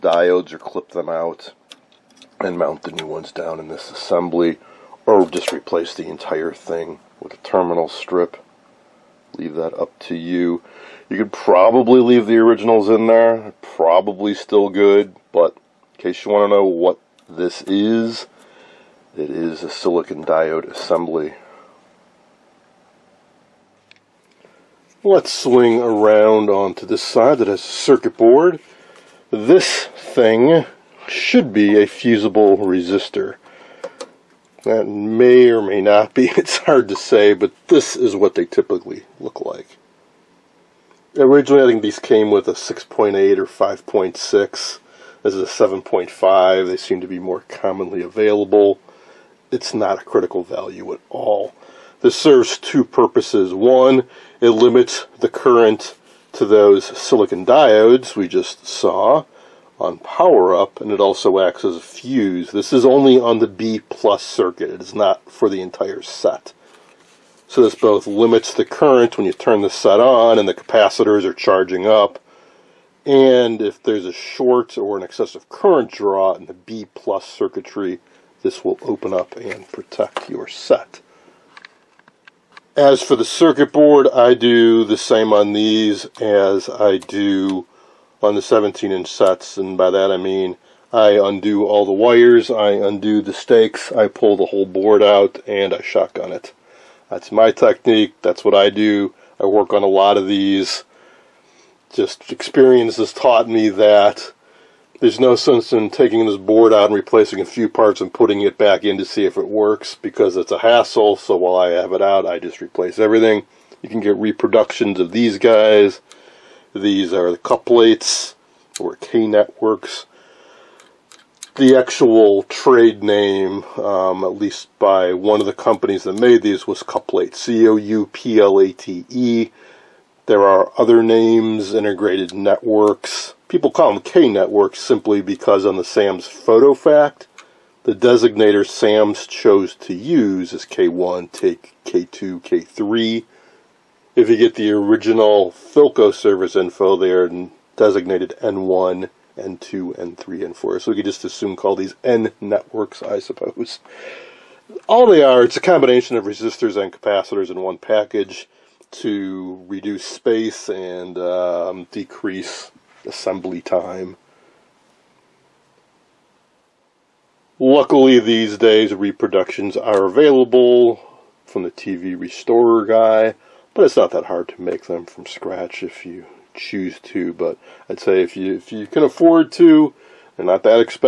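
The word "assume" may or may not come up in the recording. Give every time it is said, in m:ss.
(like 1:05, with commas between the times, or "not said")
2:31.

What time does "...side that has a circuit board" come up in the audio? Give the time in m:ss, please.
0:27.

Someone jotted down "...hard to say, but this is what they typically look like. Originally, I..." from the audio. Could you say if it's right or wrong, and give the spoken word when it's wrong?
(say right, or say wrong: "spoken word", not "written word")
right.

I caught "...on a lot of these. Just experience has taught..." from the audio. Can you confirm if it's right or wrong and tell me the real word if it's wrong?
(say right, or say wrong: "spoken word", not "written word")
right.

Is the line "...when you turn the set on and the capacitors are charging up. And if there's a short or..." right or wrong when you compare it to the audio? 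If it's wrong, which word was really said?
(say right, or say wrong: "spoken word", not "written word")
right.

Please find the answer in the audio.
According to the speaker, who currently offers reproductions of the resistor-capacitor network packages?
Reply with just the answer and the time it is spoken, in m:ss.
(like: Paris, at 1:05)
The TV restorer guy, at 2:51.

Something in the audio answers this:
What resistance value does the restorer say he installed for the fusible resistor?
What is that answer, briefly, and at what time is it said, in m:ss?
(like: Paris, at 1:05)
7.5, at 0:45.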